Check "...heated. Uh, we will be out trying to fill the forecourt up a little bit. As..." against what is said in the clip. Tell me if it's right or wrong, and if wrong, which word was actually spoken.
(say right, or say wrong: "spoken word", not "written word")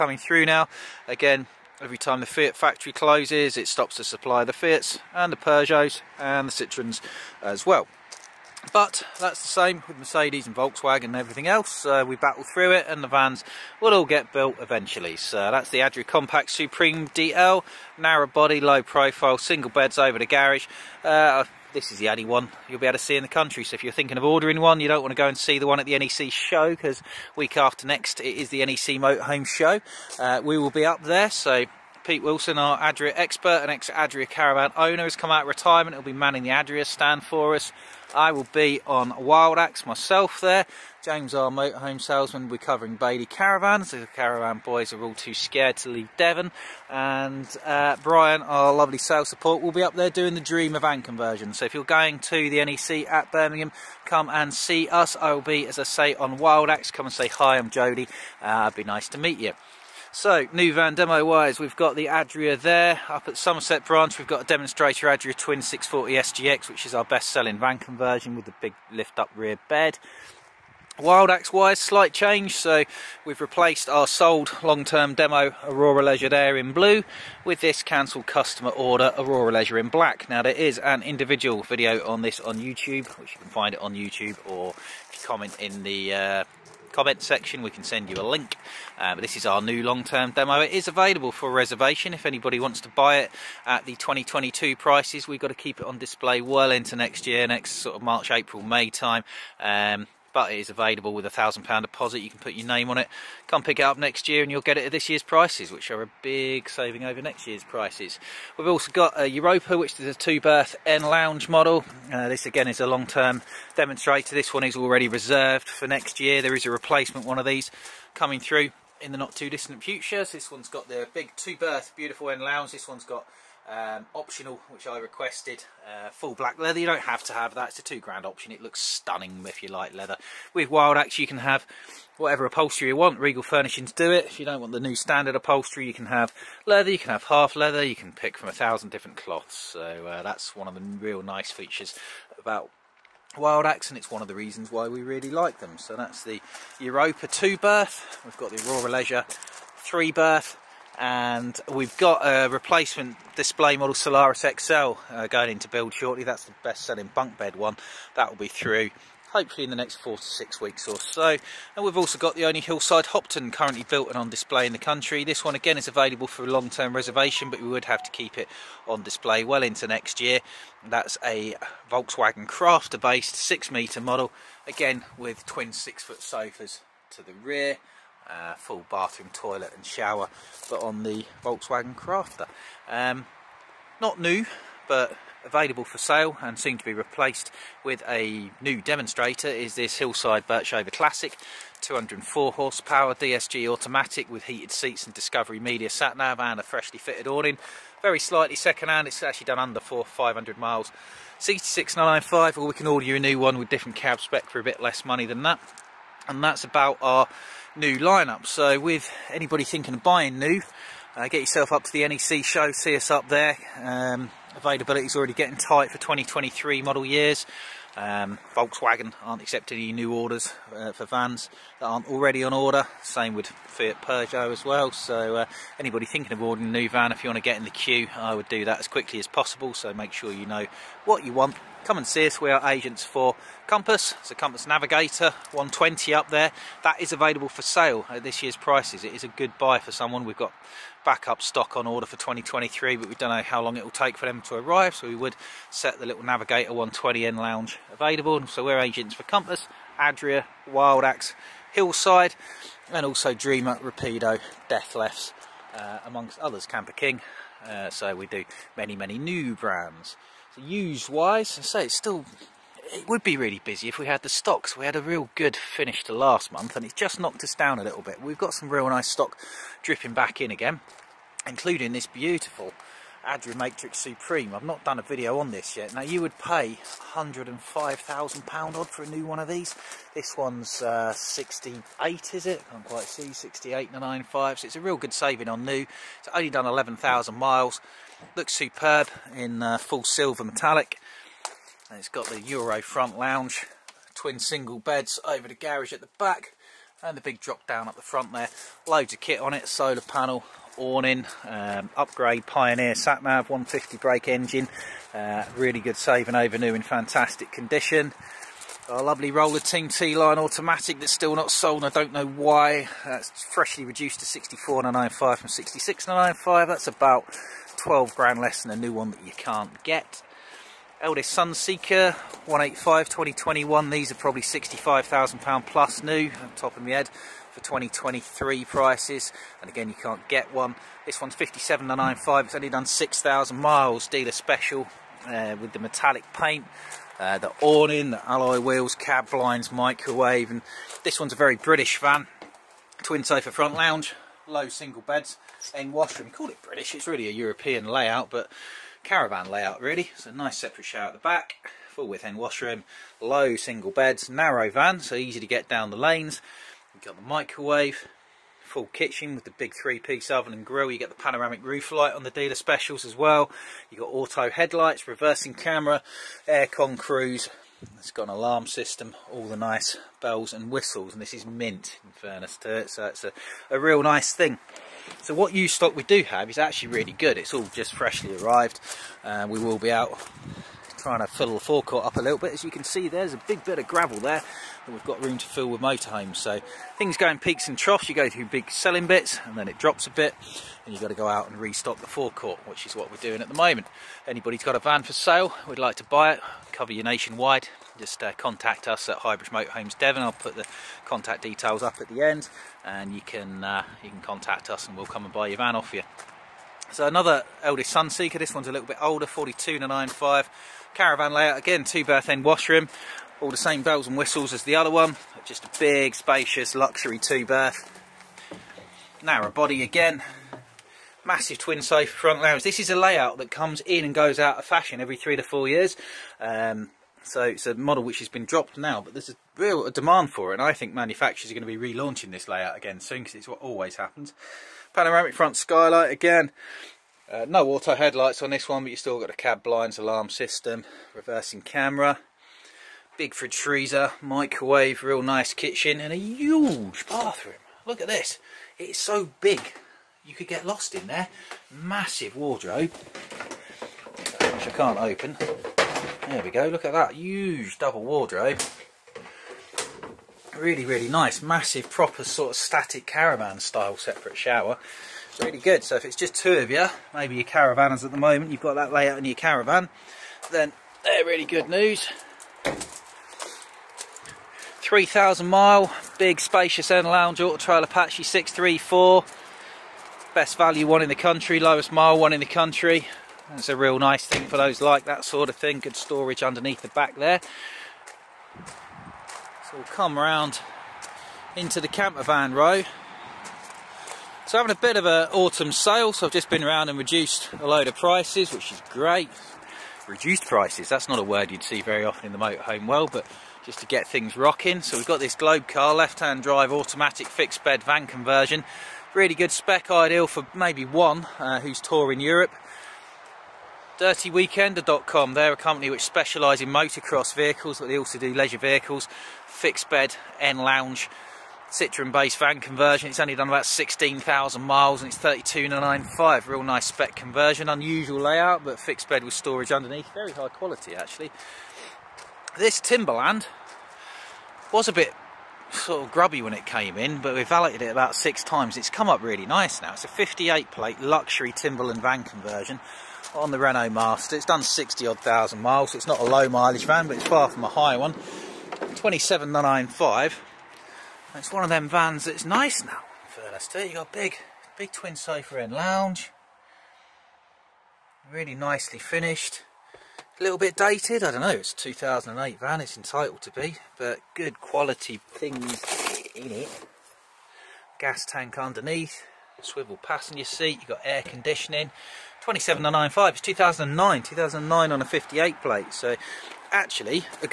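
wrong: "arrived", not "heated".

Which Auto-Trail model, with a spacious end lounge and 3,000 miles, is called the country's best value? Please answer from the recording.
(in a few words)
Apache 634.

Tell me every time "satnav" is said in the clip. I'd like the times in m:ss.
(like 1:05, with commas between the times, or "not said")
5:02.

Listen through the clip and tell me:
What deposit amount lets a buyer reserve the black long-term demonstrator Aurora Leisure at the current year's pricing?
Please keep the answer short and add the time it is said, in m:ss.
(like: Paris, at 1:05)
£1,000, at 1:41.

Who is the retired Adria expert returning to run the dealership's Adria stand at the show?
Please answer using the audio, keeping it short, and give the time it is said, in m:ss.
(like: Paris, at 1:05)
Pete Wilson, at 0:32.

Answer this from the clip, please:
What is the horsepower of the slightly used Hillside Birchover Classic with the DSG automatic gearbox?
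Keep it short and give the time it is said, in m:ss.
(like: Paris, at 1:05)
204, at 3:11.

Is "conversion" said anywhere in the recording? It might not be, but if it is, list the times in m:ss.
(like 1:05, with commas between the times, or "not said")
0:51, 1:07, 8:28, 8:42, 8:47, 9:02.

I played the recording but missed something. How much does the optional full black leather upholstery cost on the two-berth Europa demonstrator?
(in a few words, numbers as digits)
two grand.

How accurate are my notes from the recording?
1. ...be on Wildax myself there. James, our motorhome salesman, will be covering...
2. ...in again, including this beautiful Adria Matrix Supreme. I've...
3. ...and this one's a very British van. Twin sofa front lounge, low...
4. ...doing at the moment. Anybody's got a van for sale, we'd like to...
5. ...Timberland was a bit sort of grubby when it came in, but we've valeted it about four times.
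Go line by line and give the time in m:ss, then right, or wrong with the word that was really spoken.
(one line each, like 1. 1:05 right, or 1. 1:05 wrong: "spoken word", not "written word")
1. 0:38 right
2. 4:30 right
3. 5:40 right
4. 6:33 right
5. 8:52 wrong: "six", not "four".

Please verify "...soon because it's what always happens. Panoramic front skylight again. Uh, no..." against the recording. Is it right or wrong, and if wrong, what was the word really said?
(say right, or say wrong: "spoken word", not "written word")
right.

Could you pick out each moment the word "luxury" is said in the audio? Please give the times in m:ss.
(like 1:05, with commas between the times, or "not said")
6:56, 9:00.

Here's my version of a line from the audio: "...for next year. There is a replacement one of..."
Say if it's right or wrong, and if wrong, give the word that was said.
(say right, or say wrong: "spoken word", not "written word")
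right.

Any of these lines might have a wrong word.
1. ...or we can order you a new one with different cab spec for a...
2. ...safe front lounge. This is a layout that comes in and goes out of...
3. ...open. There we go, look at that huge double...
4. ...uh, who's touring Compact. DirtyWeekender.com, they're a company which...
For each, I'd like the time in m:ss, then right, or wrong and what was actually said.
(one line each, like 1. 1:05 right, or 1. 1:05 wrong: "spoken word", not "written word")
1. 3:22 right
2. 7:01 right
3. 7:34 right
4. 8:31 wrong: "Europe", not "Compact".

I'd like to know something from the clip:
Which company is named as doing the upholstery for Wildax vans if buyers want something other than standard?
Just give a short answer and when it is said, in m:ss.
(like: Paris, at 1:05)
Regal Furnishings, at 2:13.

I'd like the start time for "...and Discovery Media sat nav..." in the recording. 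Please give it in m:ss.
3:15.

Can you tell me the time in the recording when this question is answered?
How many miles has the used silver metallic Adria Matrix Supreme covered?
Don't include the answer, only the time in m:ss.
4:46.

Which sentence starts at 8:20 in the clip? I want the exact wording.
Reduced prices, that's not a word you'd see very often in the motorhome world, but just to get things rocking.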